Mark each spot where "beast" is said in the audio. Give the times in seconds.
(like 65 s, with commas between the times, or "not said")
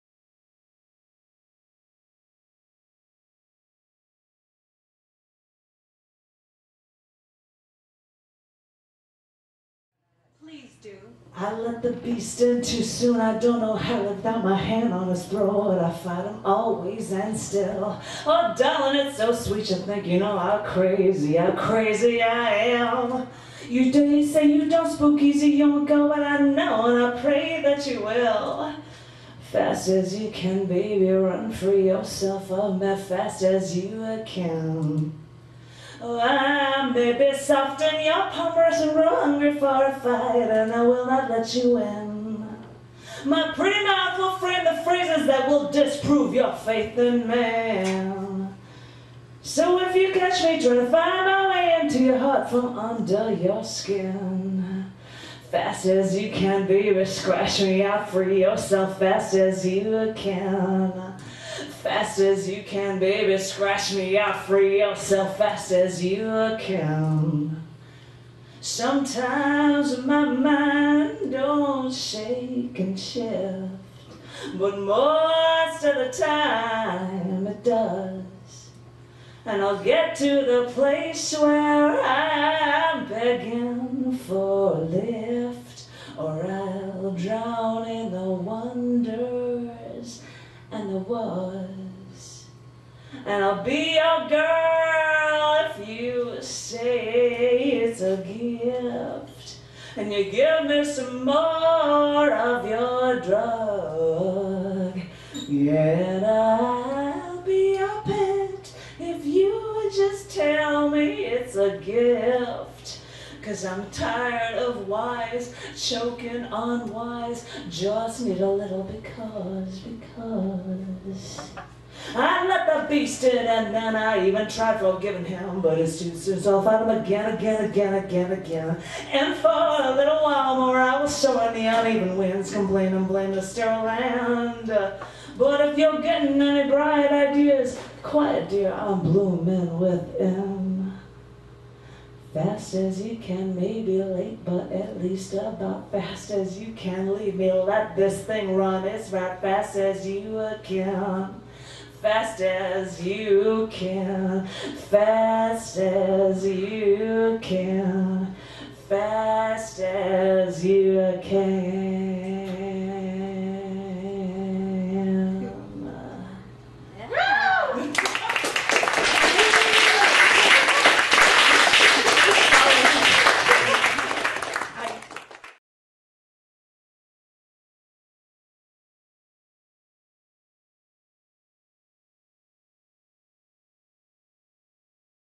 11 s, 122 s.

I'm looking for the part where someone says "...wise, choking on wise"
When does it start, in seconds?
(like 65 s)
114 s.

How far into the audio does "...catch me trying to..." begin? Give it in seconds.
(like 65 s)
50 s.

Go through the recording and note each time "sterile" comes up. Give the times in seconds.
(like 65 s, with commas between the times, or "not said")
133 s.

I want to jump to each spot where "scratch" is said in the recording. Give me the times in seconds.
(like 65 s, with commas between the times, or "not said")
57 s, 63 s.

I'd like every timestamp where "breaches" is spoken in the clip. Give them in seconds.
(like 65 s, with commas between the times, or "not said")
not said.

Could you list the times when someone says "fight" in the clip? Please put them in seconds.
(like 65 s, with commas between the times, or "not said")
15 s, 39 s, 126 s.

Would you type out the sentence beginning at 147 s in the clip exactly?
Leave me, let this thing run.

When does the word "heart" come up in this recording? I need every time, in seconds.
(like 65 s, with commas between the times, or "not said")
52 s.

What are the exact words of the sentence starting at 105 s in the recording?
Yeah, I'll be your pet if you just tell me it's a gift.